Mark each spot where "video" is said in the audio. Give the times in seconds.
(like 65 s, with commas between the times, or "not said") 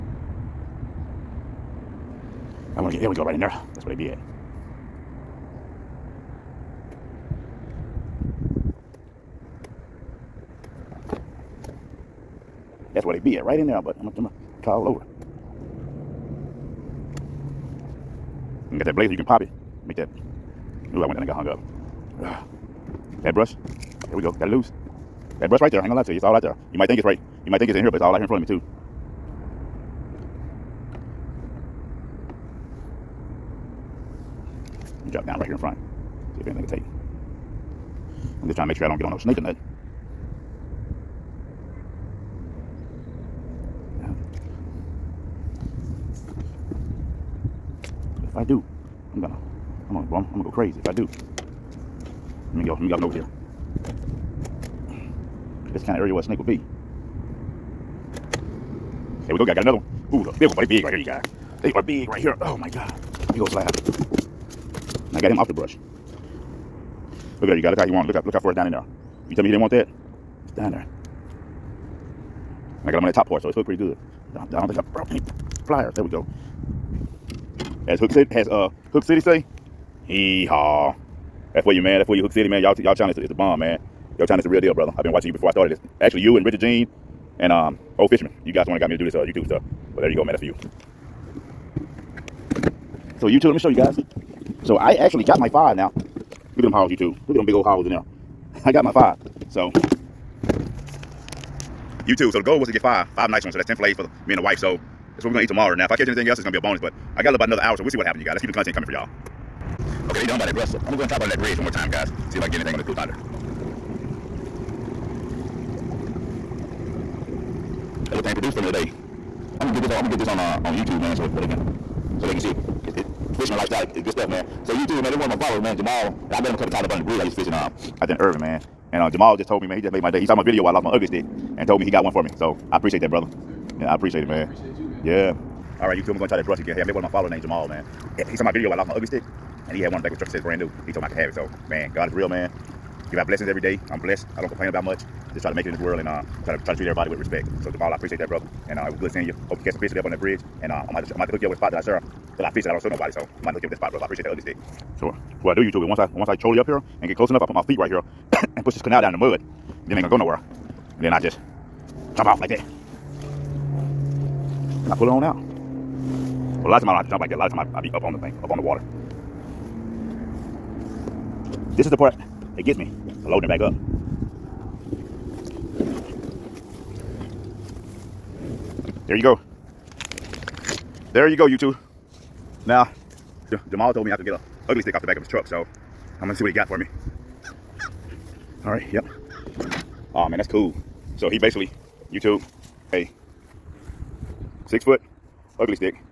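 130 s, 138 s.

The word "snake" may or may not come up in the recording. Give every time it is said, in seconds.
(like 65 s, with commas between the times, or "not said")
39 s, 56 s.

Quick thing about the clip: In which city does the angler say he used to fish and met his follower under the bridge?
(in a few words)
Irving.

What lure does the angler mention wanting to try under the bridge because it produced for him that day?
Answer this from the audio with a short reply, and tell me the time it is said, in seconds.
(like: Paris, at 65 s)
Blue Thunder, at 112 s.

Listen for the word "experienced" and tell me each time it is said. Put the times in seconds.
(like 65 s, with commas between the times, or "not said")
not said.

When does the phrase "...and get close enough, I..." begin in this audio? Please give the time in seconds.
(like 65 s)
157 s.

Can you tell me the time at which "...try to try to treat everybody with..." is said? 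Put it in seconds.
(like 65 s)
146 s.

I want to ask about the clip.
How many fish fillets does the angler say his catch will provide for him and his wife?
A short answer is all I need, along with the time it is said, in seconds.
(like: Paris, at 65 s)
10, at 103 s.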